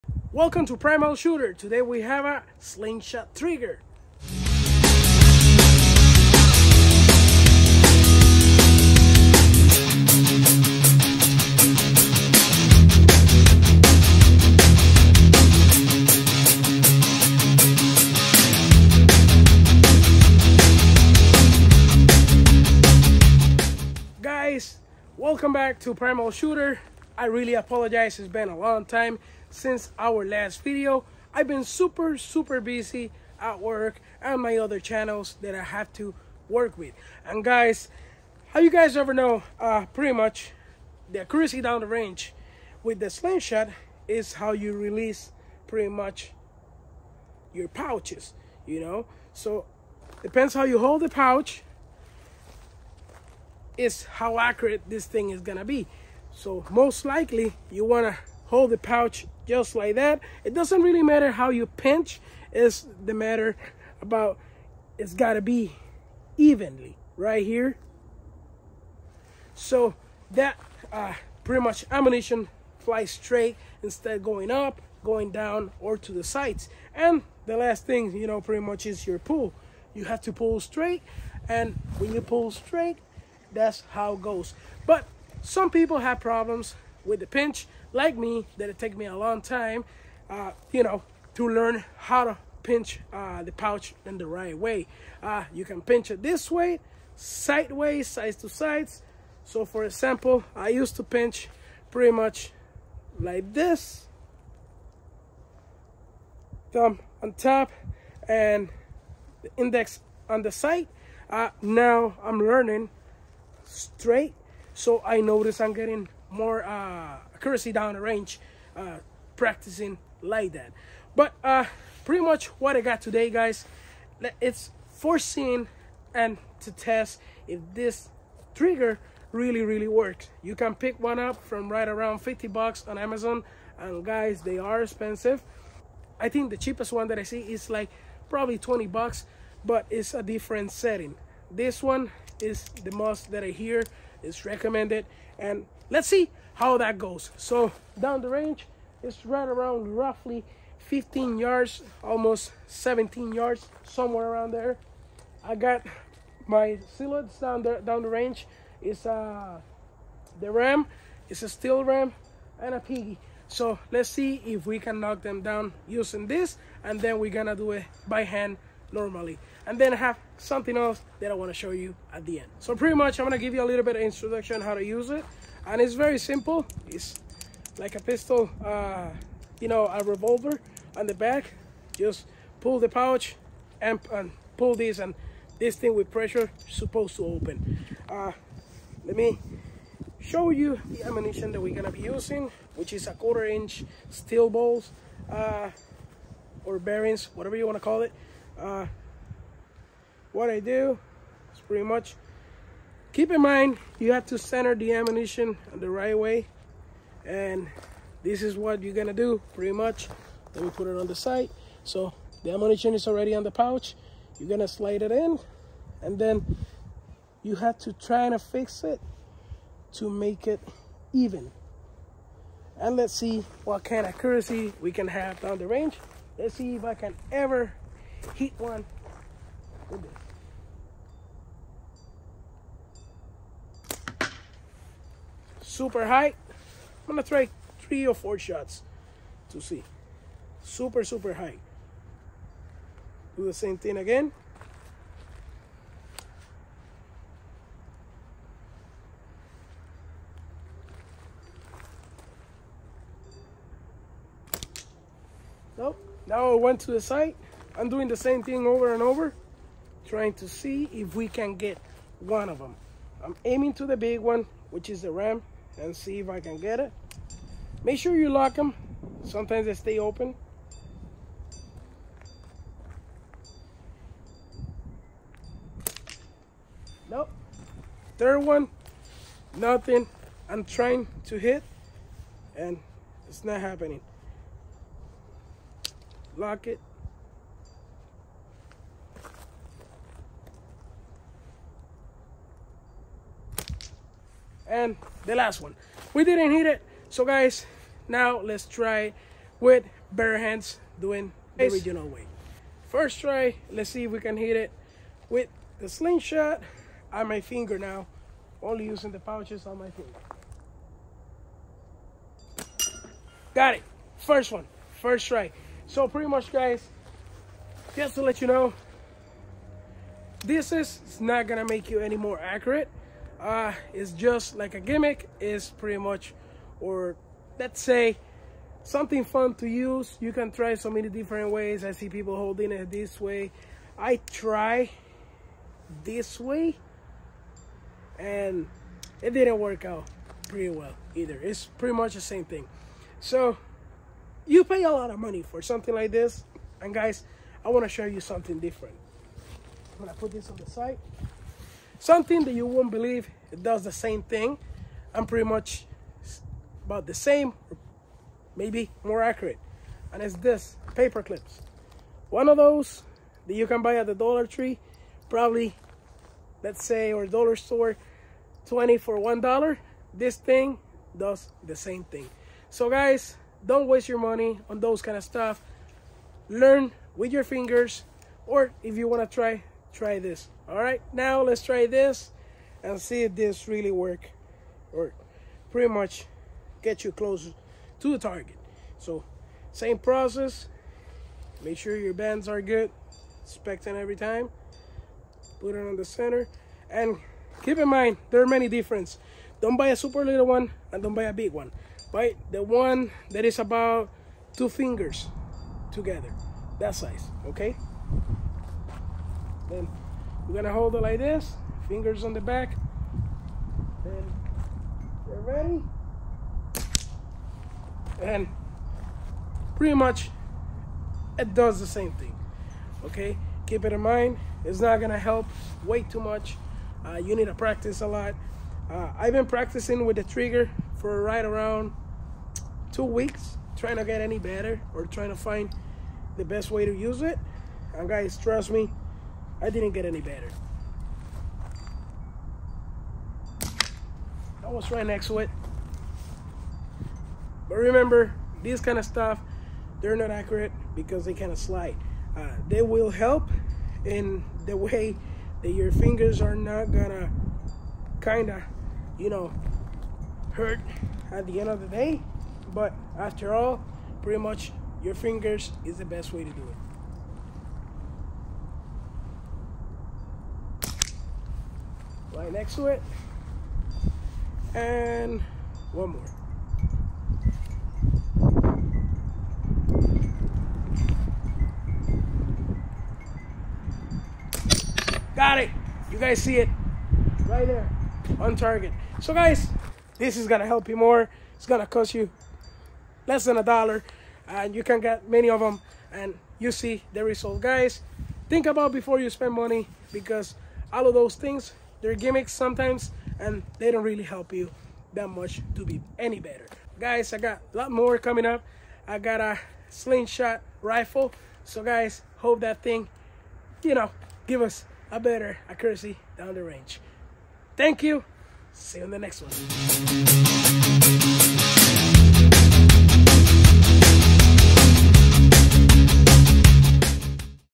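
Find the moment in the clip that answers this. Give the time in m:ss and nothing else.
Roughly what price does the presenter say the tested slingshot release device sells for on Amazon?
2:12.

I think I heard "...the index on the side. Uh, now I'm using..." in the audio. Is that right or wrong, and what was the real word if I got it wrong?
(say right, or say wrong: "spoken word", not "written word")
wrong: "learning", not "using".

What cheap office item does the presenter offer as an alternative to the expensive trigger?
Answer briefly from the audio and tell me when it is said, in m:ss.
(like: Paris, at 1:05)
Paper clips, at 6:00.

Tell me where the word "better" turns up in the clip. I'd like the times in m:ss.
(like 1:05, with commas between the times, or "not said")
7:14, 7:20, 8:26, 8:35.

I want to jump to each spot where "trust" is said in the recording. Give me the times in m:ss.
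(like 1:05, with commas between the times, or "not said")
7:18.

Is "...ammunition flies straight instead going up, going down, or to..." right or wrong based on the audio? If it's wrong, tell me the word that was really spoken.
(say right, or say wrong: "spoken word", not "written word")
right.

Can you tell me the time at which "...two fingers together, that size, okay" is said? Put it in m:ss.
6:44.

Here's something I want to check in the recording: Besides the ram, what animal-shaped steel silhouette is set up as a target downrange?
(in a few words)
Piggy.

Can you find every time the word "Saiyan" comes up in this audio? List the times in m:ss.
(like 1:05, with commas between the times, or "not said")
not said.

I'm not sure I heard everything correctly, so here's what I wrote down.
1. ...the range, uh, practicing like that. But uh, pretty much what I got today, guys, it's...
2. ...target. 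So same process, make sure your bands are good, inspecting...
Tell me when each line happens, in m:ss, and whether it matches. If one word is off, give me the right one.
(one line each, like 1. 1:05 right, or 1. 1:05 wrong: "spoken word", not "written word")
1. 1:57 right
2. 6:28 right.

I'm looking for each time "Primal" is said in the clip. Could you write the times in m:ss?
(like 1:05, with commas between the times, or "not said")
0:00, 0:25.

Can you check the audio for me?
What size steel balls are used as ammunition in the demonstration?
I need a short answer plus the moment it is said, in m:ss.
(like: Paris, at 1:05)
Quarter inch, at 3:13.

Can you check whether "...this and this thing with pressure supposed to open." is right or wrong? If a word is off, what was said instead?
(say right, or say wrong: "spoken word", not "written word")
right.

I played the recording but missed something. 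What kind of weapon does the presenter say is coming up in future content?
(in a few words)
Slingshot rifle.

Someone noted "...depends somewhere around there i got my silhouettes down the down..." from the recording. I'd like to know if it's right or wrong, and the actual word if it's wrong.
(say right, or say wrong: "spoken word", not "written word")
wrong: "yards", not "depends".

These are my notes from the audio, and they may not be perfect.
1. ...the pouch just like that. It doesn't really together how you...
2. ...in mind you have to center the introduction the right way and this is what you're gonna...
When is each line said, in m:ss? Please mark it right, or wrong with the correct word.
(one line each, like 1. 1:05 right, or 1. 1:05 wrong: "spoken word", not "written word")
1. 0:58 wrong: "matter", not "together"
2. 3:23 wrong: "ammunition", not "introduction".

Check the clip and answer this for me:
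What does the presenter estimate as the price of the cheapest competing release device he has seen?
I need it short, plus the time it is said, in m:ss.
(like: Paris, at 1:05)
$20, at 2:18.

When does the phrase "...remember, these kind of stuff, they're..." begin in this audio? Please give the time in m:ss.
7:27.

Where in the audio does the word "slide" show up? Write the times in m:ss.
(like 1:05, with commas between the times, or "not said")
3:34, 7:31.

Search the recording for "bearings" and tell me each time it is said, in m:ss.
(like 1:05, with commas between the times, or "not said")
3:16.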